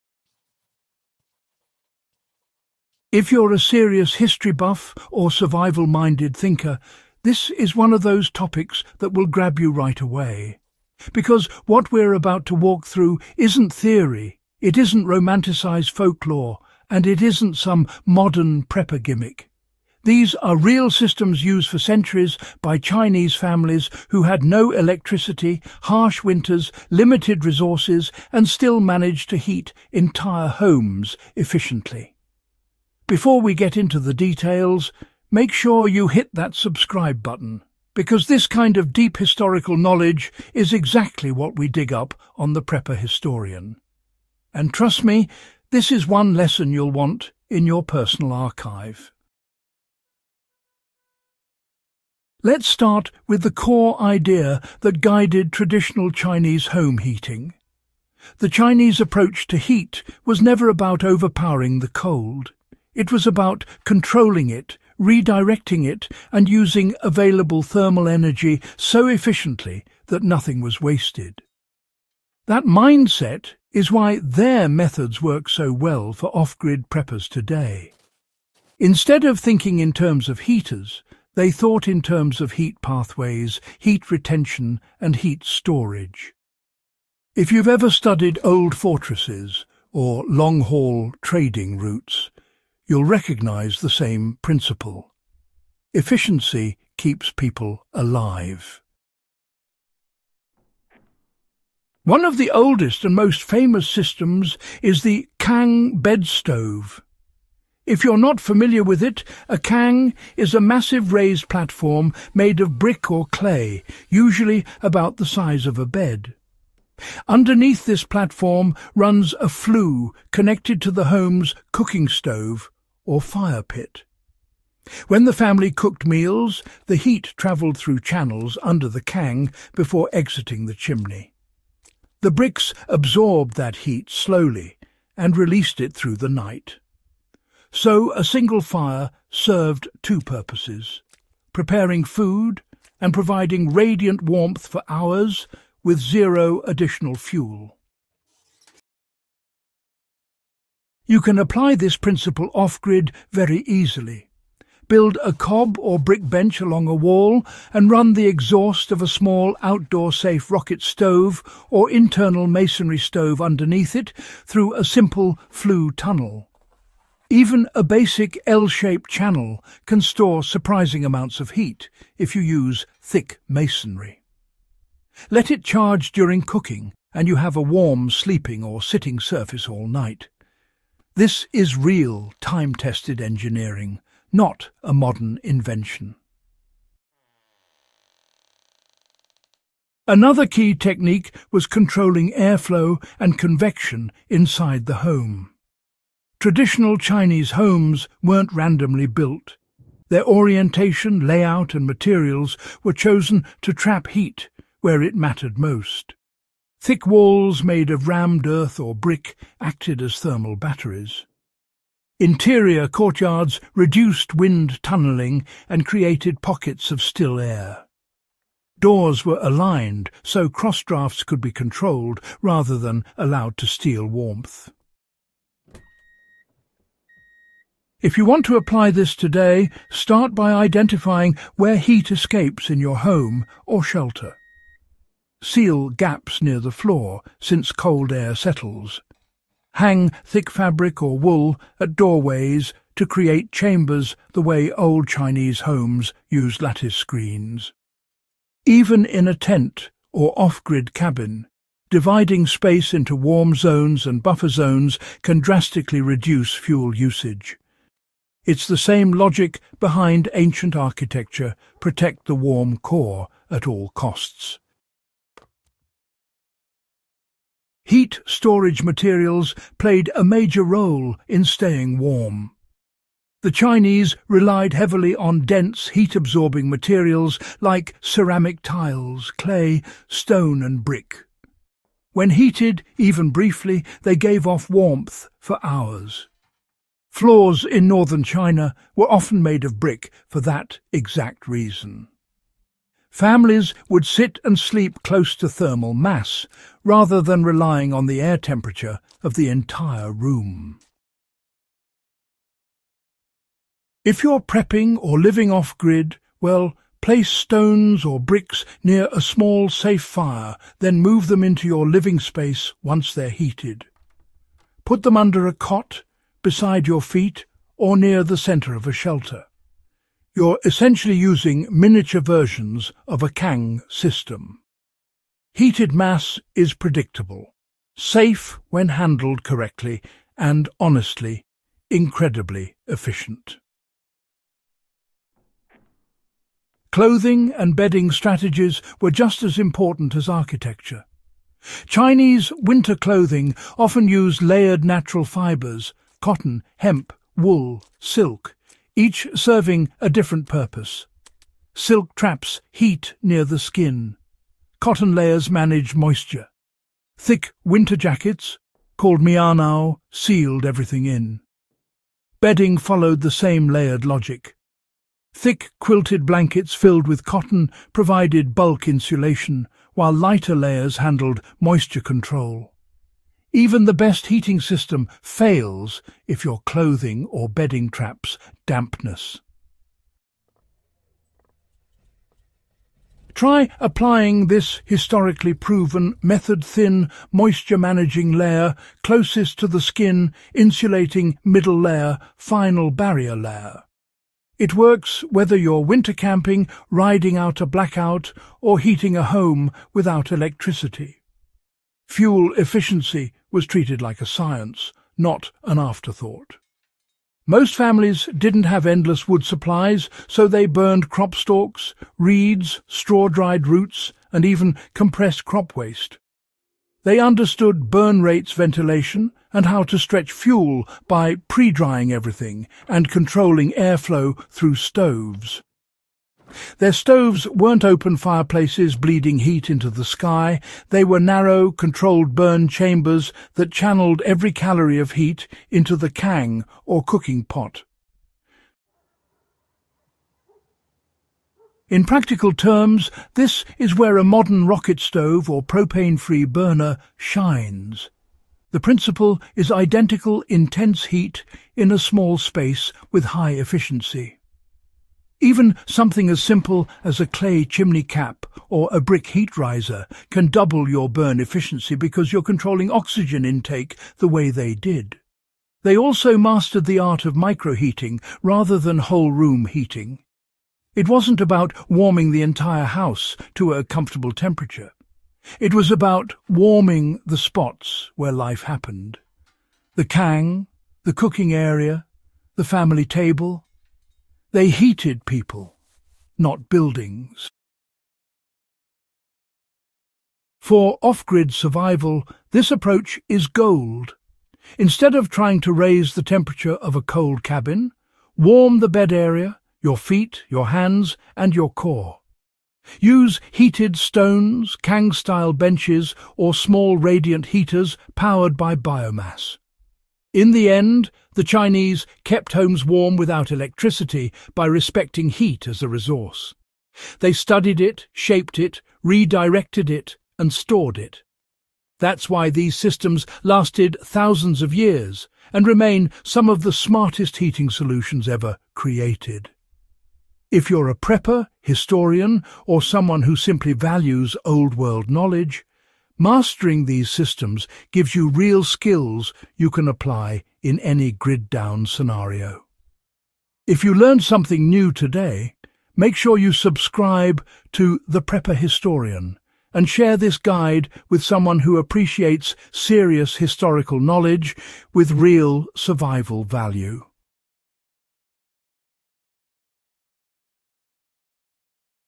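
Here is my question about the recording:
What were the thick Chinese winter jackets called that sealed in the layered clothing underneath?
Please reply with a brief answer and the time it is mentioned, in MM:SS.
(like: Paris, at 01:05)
mianao, at 05:59.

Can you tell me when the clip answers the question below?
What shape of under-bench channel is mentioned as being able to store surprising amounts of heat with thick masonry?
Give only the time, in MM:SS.
02:48.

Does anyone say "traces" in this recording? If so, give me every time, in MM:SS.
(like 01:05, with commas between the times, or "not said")
not said.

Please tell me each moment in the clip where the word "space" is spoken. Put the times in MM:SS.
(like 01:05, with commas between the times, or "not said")
04:12, 05:12, 07:32.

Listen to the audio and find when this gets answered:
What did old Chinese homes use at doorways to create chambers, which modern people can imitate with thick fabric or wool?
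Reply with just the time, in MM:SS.
04:06.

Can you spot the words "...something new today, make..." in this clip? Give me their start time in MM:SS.
09:04.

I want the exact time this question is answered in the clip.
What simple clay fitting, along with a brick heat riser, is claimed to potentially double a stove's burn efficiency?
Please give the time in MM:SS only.
07:37.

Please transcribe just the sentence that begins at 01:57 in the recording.
Underneath this platform runs a flue connected to the home's cooking stove, or fire pit.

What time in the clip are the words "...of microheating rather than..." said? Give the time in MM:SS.
07:47.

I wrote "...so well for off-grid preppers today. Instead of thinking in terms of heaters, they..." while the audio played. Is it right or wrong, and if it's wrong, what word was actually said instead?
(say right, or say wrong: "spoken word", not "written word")
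right.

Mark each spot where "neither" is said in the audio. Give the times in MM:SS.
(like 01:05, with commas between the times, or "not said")
not said.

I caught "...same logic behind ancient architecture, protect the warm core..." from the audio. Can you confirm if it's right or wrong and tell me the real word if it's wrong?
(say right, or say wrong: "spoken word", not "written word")
right.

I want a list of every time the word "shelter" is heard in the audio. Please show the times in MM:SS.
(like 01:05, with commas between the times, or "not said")
03:53, 05:18.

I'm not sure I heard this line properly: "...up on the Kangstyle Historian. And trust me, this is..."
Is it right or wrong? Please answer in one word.
wrong.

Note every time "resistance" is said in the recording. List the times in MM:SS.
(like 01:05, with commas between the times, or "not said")
not said.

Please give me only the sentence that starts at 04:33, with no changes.
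The Chinese relied heavily on dense heat-absorbing materials like ceramic tiles, clay, stone and brick.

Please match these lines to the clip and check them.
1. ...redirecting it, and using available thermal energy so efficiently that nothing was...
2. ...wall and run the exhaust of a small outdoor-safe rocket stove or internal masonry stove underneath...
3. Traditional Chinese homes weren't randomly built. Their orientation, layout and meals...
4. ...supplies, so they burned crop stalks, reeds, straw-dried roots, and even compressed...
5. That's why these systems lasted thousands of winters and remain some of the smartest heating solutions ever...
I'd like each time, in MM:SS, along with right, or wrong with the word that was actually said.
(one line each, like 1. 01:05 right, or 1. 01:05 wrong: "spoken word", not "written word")
1. 01:04 right
2. 02:36 right
3. 03:16 wrong: "materials", not "meals"
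4. 06:49 right
5. 08:41 wrong: "years", not "winters".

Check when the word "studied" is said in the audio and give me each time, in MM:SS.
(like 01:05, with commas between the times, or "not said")
01:27, 08:37.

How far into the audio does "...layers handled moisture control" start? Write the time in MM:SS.
06:10.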